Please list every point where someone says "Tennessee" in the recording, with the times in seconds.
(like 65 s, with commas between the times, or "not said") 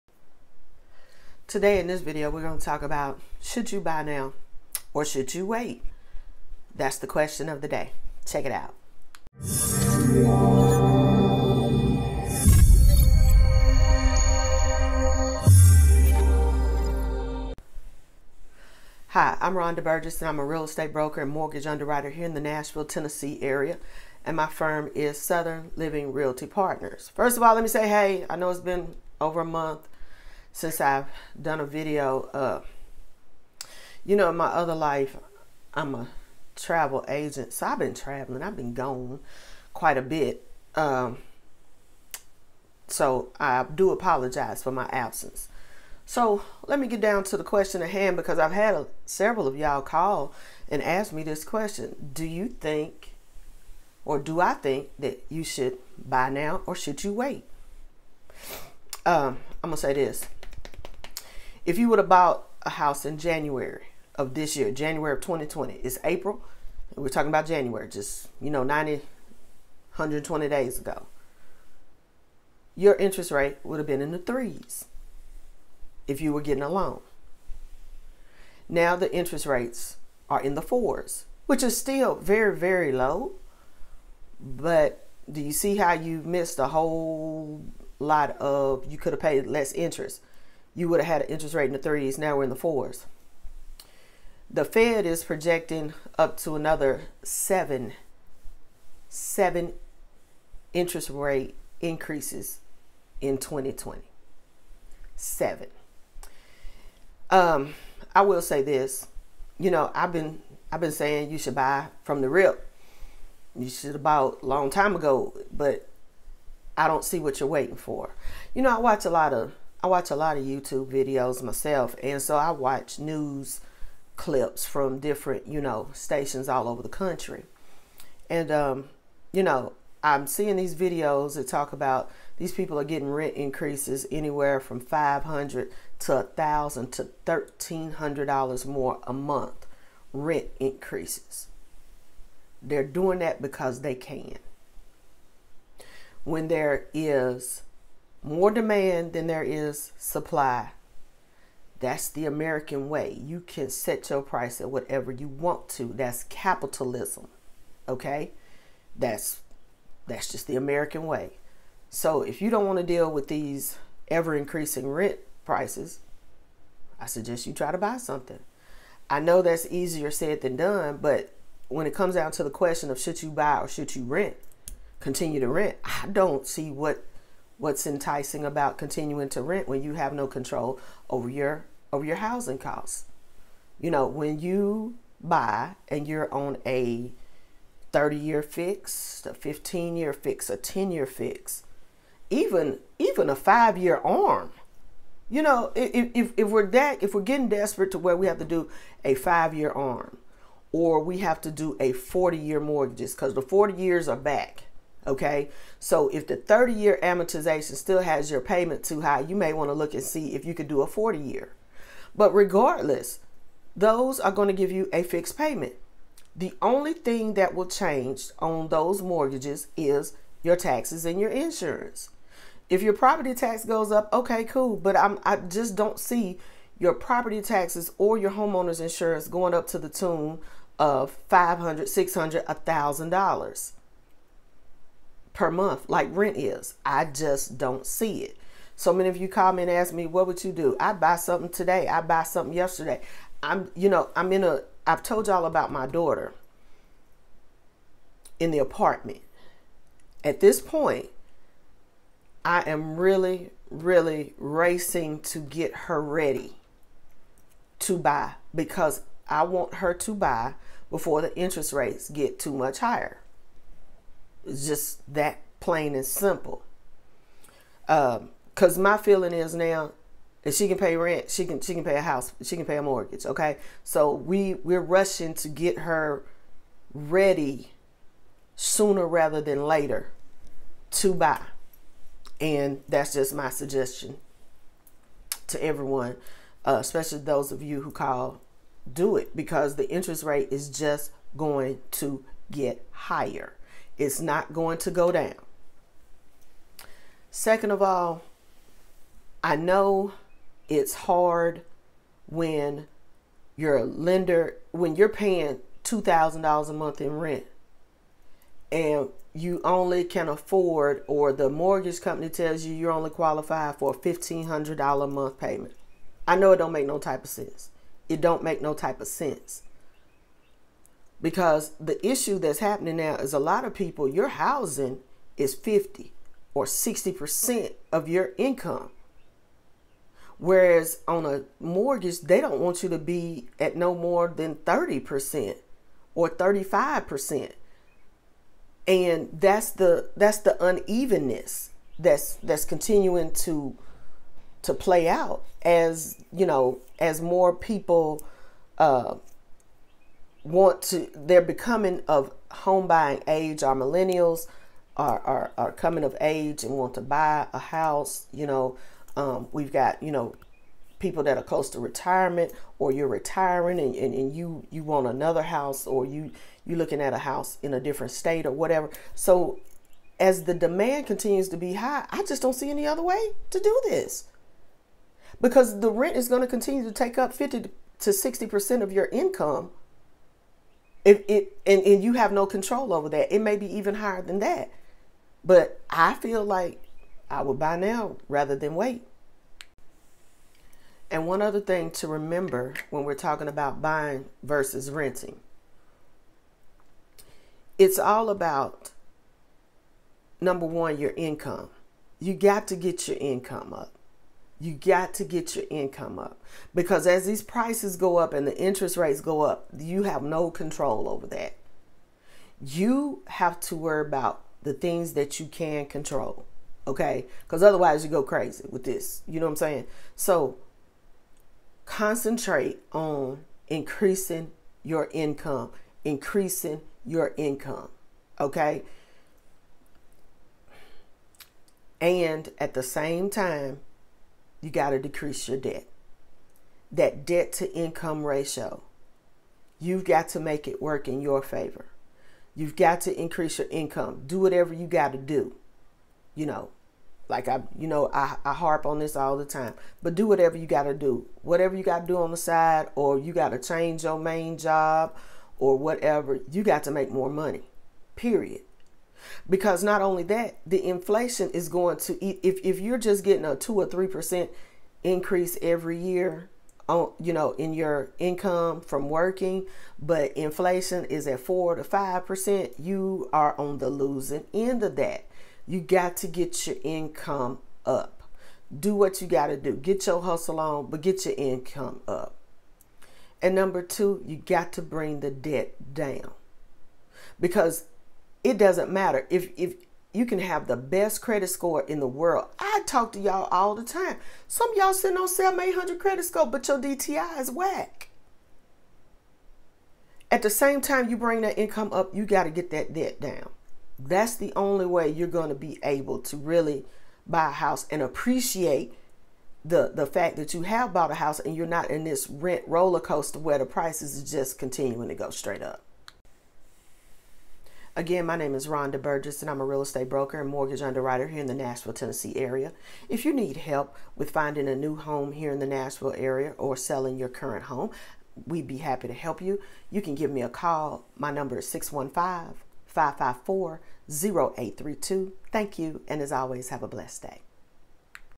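22 s, 521 s.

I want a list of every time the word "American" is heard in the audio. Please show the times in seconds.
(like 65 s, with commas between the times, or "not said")
152 s, 160 s.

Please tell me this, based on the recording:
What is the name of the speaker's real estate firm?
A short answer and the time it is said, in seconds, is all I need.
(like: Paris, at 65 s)
Southern Living Realty Partners, at 25 s.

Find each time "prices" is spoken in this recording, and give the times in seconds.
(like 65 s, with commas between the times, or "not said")
154 s, 165 s, 407 s, 513 s.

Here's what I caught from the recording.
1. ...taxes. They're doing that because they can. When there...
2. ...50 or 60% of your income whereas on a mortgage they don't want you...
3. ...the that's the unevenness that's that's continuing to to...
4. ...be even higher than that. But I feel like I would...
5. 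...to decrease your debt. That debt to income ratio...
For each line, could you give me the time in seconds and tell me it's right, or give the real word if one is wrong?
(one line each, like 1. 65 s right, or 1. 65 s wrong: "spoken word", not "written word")
1. 140 s wrong: "increases", not "taxes"
2. 325 s right
3. 339 s right
4. 383 s right
5. 434 s right.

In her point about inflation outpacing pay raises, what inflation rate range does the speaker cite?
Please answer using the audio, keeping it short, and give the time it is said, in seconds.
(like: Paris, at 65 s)
4 to 5%, at 471 s.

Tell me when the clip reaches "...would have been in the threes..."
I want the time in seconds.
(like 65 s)
73 s.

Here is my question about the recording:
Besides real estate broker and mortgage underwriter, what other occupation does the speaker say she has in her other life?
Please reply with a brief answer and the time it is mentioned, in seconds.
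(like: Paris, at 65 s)
travel agent, at 36 s.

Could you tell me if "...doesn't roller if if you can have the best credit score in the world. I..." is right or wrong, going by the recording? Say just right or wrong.
wrong.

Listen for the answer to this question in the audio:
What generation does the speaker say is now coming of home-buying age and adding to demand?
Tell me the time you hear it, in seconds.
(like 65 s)
353 s.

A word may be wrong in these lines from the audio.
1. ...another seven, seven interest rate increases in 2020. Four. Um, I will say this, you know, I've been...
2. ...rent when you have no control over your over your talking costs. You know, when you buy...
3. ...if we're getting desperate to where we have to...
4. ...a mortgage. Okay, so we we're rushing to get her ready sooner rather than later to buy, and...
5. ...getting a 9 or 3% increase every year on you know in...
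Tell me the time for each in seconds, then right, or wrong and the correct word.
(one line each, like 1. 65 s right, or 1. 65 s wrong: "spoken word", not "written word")
1. 96 s wrong: "Seven", not "Four"
2. 179 s wrong: "housing", not "talking"
3. 197 s right
4. 272 s right
5. 463 s wrong: "2", not "9".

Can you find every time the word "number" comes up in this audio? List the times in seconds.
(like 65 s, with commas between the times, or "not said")
400 s, 483 s, 531 s.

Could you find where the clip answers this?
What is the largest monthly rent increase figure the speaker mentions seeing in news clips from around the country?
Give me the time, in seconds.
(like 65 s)
137 s.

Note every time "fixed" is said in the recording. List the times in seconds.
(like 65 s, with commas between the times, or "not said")
215 s.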